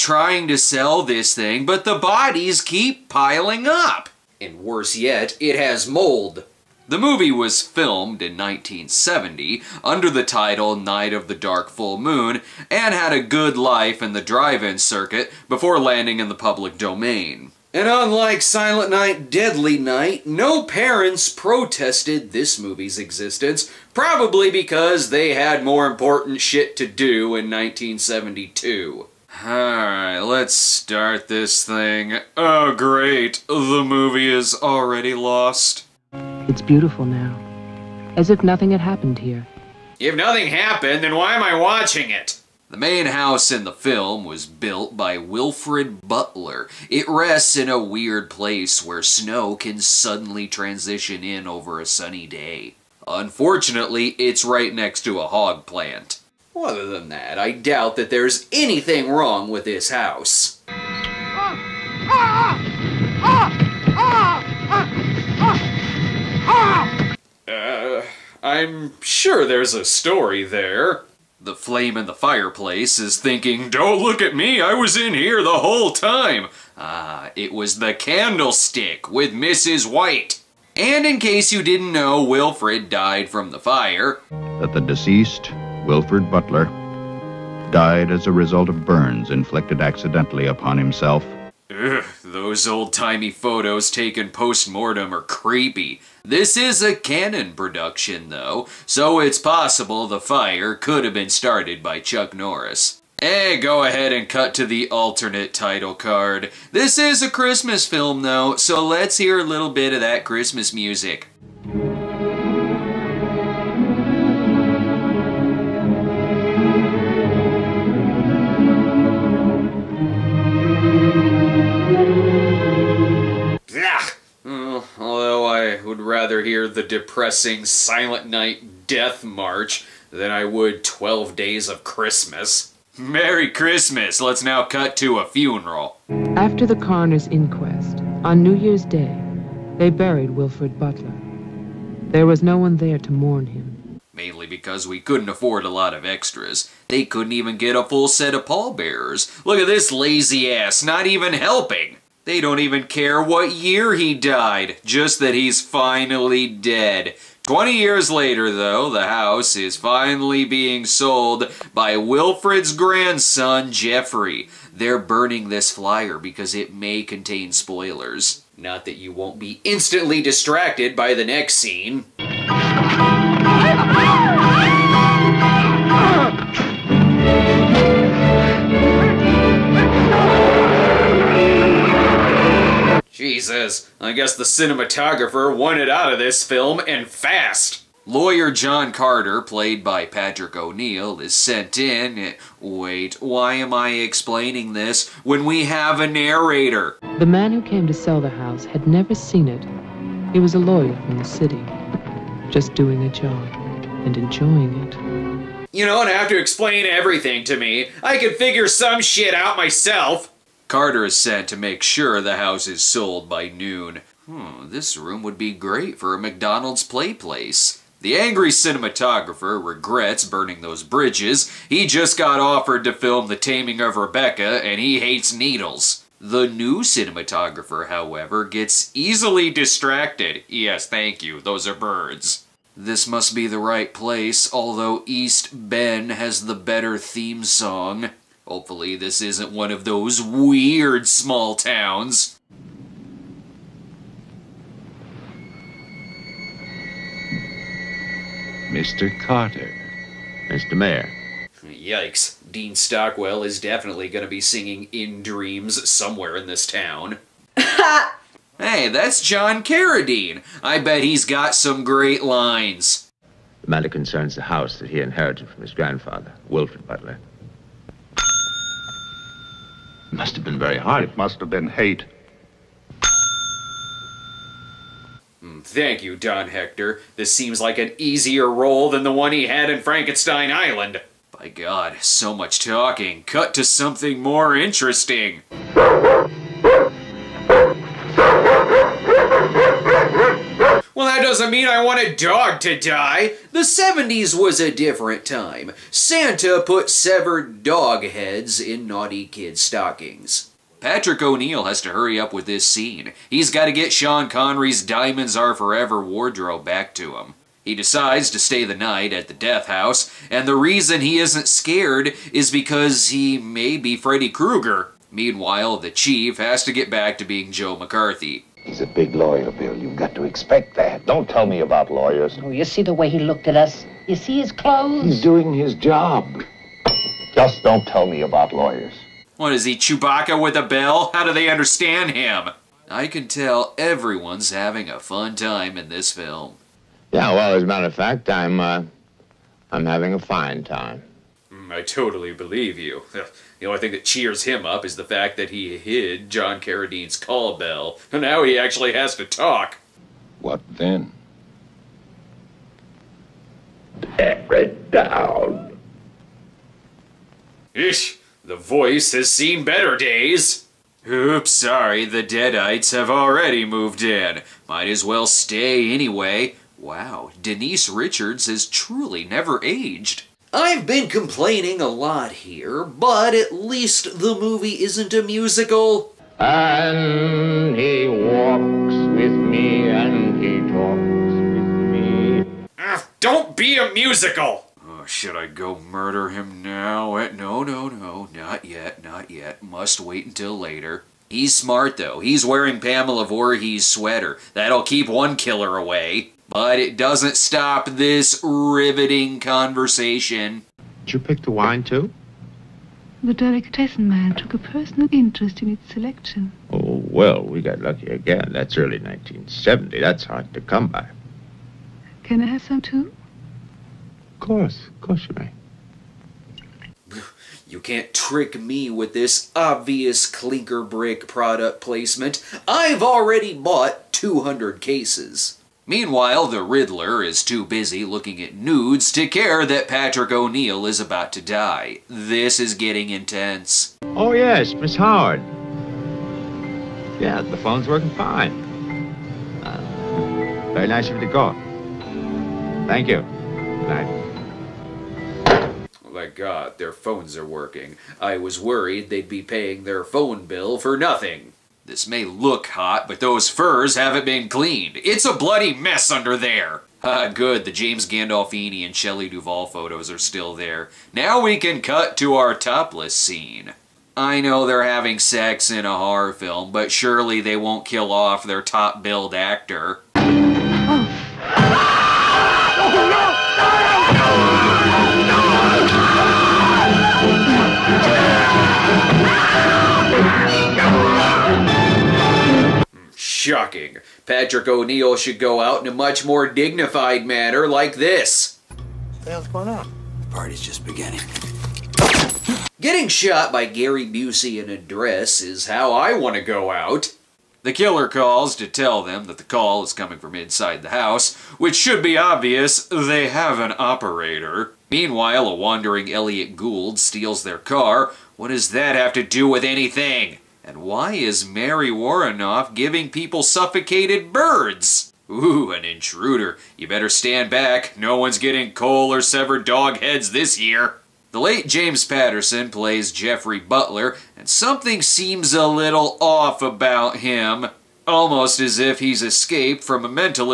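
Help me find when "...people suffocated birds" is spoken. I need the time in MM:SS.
08:33.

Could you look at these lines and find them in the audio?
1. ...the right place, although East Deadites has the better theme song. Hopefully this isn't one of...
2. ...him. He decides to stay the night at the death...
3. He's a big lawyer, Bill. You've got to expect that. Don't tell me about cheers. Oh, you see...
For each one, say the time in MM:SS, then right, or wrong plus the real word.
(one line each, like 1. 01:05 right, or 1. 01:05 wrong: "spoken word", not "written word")
1. 03:53 wrong: "Ben", not "Deadites"
2. 05:07 right
3. 05:18 wrong: "lawyers", not "cheers".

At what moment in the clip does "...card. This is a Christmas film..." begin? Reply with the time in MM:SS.
01:45.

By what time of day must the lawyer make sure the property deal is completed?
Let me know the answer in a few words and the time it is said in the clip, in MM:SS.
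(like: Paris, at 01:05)
Noon, at 03:33.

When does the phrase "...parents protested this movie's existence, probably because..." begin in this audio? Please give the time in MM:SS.
00:20.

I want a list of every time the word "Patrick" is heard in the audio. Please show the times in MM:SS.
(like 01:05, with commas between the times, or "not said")
03:10, 05:00, 07:09, 08:04.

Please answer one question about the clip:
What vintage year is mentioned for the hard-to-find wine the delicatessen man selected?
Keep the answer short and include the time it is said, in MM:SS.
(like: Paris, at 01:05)
1970, at 06:48.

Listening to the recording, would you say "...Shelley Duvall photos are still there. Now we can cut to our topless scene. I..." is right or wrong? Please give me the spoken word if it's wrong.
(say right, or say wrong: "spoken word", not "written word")
right.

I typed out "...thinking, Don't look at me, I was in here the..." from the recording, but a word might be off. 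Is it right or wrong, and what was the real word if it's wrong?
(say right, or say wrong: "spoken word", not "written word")
right.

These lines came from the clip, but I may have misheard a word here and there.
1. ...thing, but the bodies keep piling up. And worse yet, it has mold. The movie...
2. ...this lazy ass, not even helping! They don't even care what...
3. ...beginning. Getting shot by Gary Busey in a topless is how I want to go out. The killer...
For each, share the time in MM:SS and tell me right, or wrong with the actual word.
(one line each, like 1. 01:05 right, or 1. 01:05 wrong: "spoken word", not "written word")
1. 00:01 right
2. 02:29 right
3. 08:10 wrong: "dress", not "topless".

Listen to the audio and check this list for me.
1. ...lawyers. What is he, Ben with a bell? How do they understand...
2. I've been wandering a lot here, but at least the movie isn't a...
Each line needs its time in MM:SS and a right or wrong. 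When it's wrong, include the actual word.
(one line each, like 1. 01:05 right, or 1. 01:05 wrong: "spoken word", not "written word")
1. 05:28 wrong: "Chewbacca", not "Ben"
2. 06:10 wrong: "complaining", not "wandering".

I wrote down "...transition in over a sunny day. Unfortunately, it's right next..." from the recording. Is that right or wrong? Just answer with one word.
right.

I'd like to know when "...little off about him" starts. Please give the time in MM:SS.
08:45.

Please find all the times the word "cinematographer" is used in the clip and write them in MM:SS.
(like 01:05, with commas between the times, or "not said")
03:04, 03:38, 03:46.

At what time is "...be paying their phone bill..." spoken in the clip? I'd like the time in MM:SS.
07:29.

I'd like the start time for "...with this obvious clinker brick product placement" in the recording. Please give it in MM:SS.
06:58.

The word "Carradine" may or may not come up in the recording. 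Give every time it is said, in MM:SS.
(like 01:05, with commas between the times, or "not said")
04:19, 05:46.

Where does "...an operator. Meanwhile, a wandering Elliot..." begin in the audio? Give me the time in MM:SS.
08:23.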